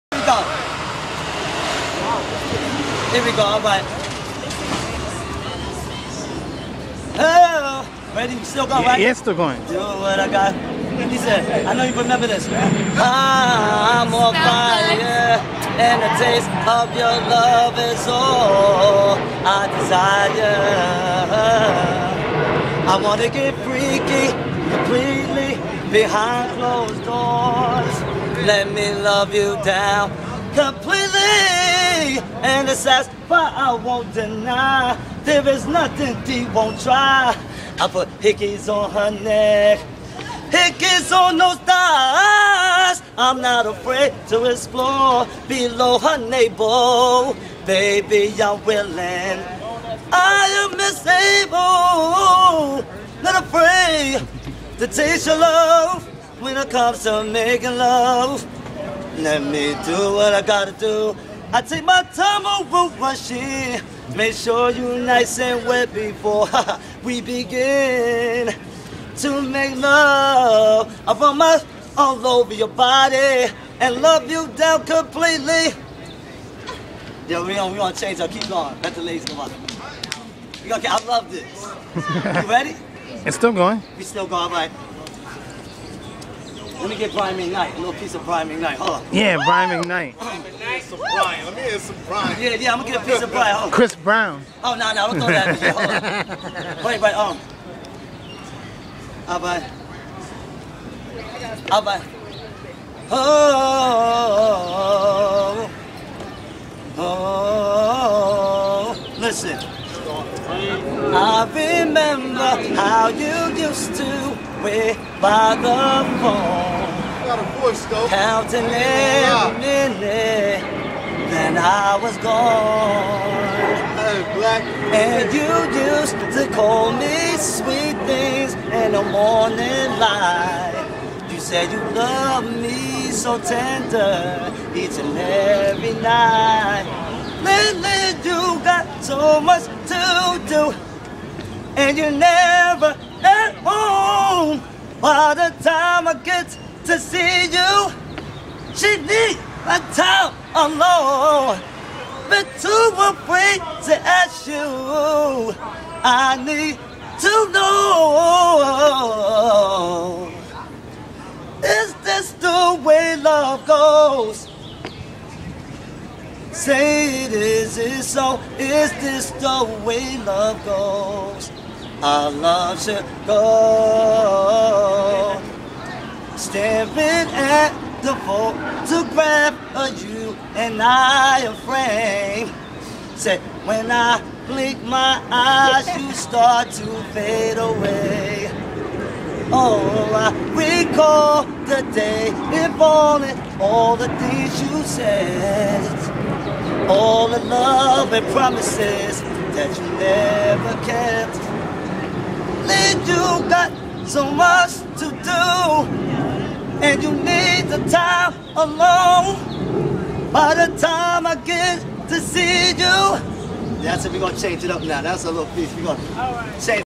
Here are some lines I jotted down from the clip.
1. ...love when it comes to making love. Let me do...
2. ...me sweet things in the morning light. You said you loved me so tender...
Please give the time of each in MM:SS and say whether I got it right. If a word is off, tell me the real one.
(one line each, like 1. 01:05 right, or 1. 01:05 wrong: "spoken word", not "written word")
1. 00:55 right
2. 02:06 right.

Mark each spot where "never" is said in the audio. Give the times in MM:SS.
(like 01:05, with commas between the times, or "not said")
02:22, 03:19.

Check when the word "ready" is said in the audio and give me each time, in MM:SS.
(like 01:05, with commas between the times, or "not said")
00:08, 01:22.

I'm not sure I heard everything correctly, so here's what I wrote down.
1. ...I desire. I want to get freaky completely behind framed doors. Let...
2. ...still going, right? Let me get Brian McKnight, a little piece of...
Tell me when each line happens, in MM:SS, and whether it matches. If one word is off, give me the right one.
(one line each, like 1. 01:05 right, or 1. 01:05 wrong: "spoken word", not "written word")
1. 00:19 wrong: "closed", not "framed"
2. 01:24 right.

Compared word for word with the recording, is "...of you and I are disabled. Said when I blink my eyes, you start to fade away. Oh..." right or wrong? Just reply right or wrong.
wrong.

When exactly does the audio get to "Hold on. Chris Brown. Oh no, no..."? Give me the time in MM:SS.
01:33.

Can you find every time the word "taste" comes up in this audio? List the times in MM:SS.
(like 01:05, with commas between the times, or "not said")
00:16, 00:54.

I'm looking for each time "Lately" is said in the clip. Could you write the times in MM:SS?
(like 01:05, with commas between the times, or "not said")
02:17.